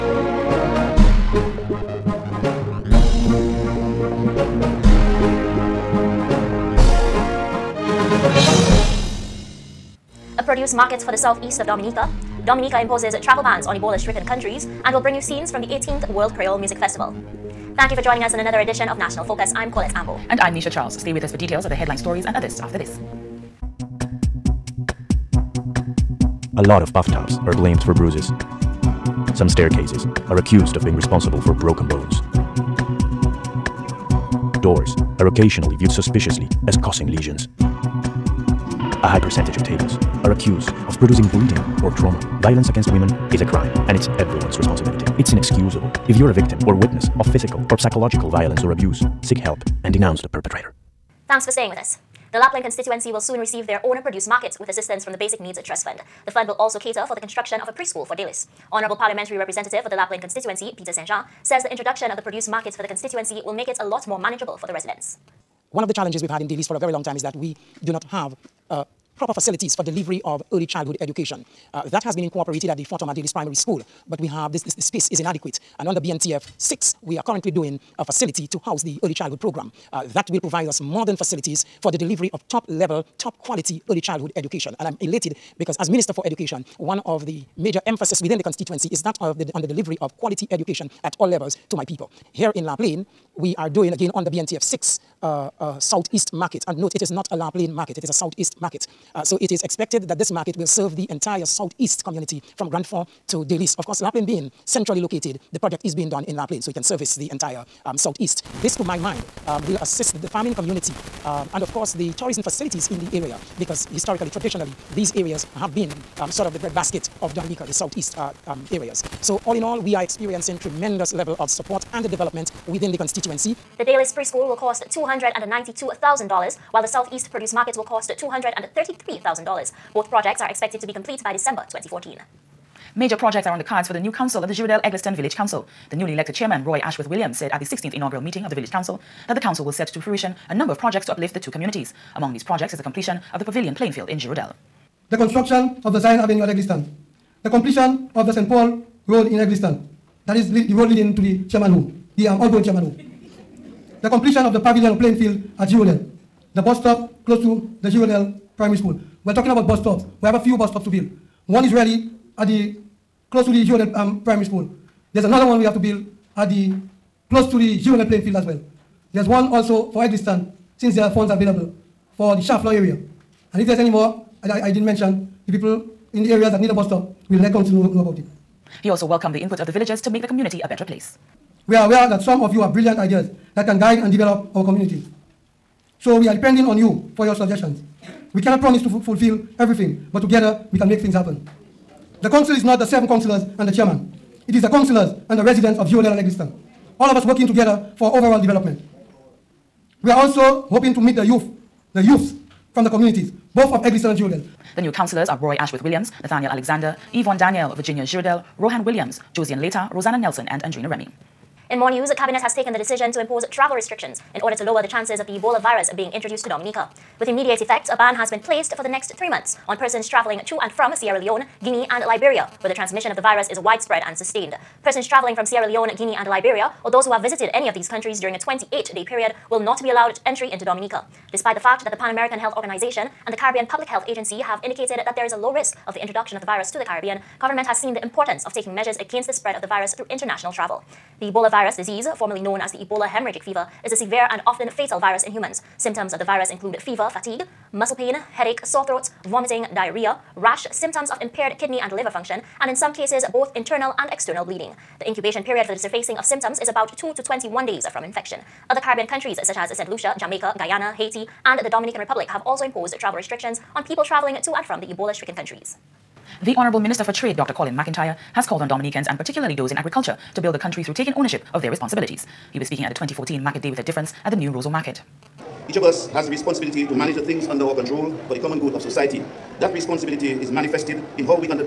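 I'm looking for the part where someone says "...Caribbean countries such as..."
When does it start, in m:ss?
4:18.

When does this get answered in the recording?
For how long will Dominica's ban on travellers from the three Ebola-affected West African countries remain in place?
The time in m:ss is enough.
3:39.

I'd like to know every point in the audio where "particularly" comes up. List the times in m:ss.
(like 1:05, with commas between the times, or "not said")
4:29.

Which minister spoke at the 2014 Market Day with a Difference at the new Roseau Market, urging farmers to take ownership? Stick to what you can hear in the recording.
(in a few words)
Dr. Colin McIntyre.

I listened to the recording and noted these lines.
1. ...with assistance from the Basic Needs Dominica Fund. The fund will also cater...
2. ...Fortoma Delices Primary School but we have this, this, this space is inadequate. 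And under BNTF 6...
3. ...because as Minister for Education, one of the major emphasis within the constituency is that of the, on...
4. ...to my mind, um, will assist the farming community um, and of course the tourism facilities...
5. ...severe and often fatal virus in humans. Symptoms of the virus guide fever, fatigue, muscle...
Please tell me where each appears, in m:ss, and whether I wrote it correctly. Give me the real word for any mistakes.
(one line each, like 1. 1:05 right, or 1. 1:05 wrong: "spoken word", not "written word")
1. 0:54 wrong: "Trust", not "Dominica"
2. 1:12 right
3. 1:25 right
4. 1:48 right
5. 4:03 wrong: "include", not "guide".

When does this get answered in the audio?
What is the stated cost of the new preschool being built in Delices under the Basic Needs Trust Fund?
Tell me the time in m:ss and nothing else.
2:04.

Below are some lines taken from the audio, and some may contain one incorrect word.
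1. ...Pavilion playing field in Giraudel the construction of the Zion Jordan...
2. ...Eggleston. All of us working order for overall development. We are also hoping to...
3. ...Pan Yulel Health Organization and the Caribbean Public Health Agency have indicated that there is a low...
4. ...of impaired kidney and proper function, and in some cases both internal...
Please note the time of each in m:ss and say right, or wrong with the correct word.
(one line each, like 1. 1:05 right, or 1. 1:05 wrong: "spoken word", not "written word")
1. 2:23 wrong: "Avenue", not "Jordan"
2. 3:16 wrong: "together", not "order"
3. 3:51 wrong: "American", not "Yulel"
4. 4:11 wrong: "liver", not "proper".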